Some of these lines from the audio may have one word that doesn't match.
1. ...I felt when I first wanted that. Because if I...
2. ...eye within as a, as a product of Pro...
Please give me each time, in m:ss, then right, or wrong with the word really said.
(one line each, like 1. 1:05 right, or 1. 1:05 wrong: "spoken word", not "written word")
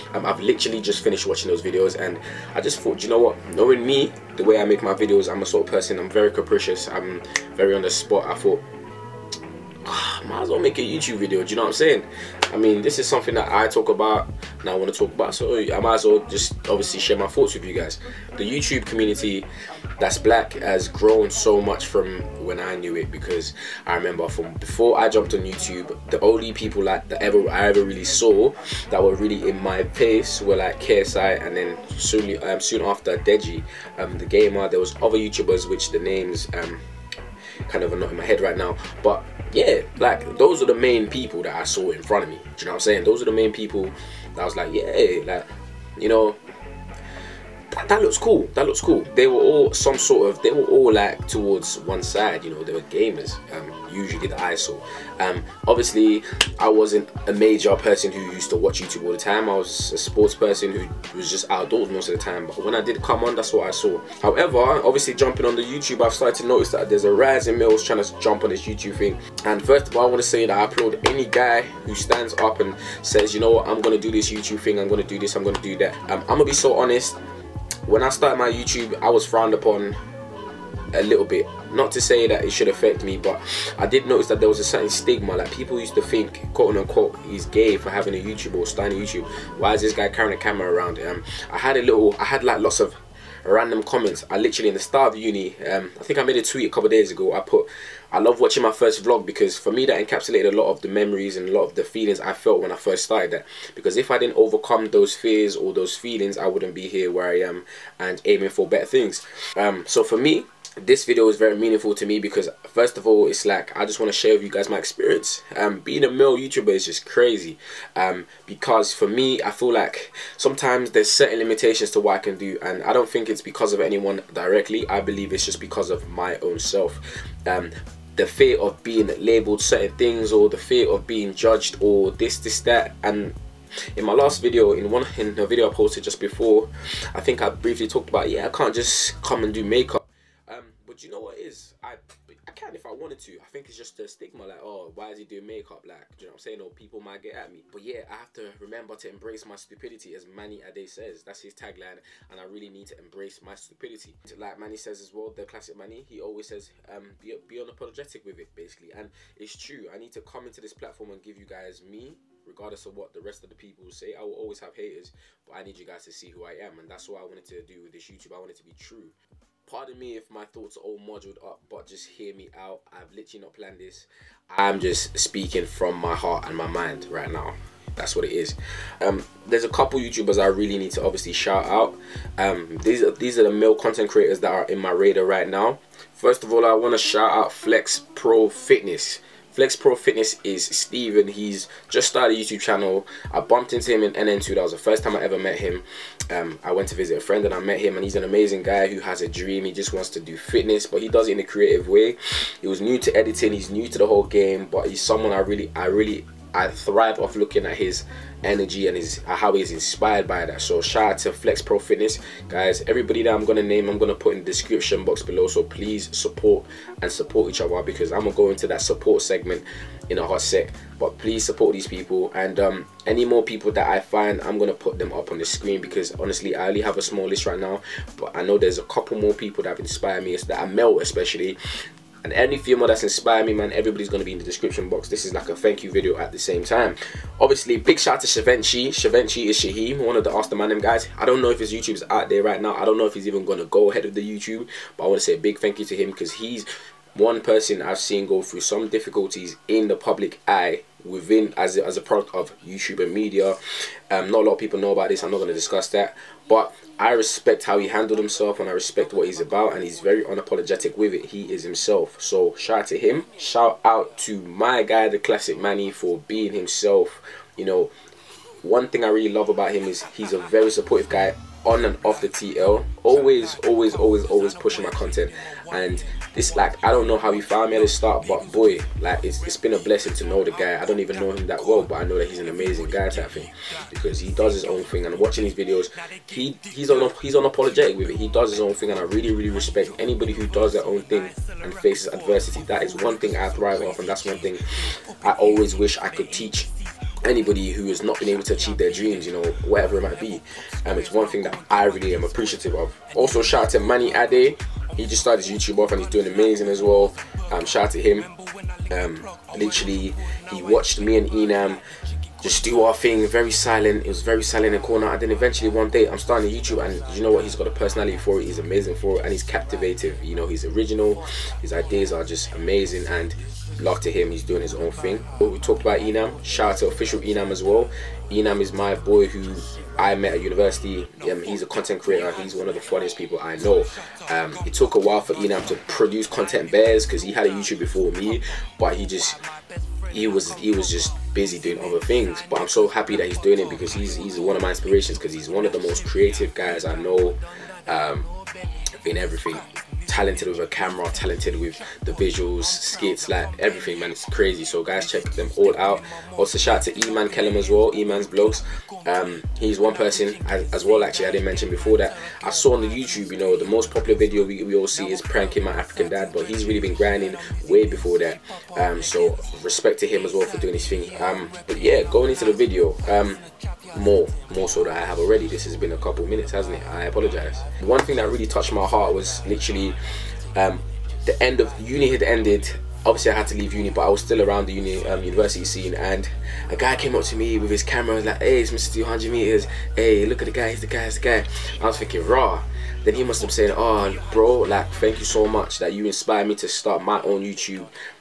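1. 1:42 wrong: "started", not "wanted"
2. 4:10 wrong: "YouTube", not "Pro".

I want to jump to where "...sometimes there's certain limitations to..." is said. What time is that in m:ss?
2:00.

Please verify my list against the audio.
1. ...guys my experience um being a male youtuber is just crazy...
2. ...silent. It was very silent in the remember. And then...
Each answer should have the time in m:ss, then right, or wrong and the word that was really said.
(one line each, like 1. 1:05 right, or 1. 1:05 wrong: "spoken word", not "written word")
1. 1:54 right
2. 5:13 wrong: "corner", not "remember".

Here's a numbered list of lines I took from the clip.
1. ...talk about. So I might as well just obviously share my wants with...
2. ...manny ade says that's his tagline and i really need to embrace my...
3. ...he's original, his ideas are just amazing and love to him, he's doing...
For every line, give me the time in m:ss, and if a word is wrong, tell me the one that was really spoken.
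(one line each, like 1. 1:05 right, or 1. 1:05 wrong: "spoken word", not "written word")
1. 0:14 wrong: "thoughts", not "wants"
2. 2:30 right
3. 5:20 right.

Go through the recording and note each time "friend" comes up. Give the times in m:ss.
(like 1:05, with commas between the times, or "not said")
3:17.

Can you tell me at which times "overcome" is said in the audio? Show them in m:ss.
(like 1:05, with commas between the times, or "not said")
1:44.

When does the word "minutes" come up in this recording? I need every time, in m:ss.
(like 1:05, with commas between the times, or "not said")
6:16.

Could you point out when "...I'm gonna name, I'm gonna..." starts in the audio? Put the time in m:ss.
3:33.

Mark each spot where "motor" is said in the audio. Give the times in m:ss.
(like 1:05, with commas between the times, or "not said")
not said.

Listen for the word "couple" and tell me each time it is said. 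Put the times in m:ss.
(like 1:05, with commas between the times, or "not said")
1:36, 2:59, 3:48, 6:15.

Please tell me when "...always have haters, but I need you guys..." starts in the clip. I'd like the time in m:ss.
2:44.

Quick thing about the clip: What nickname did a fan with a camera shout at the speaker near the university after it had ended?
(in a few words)
Mr. 200 meters.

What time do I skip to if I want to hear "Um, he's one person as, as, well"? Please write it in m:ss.
5:59.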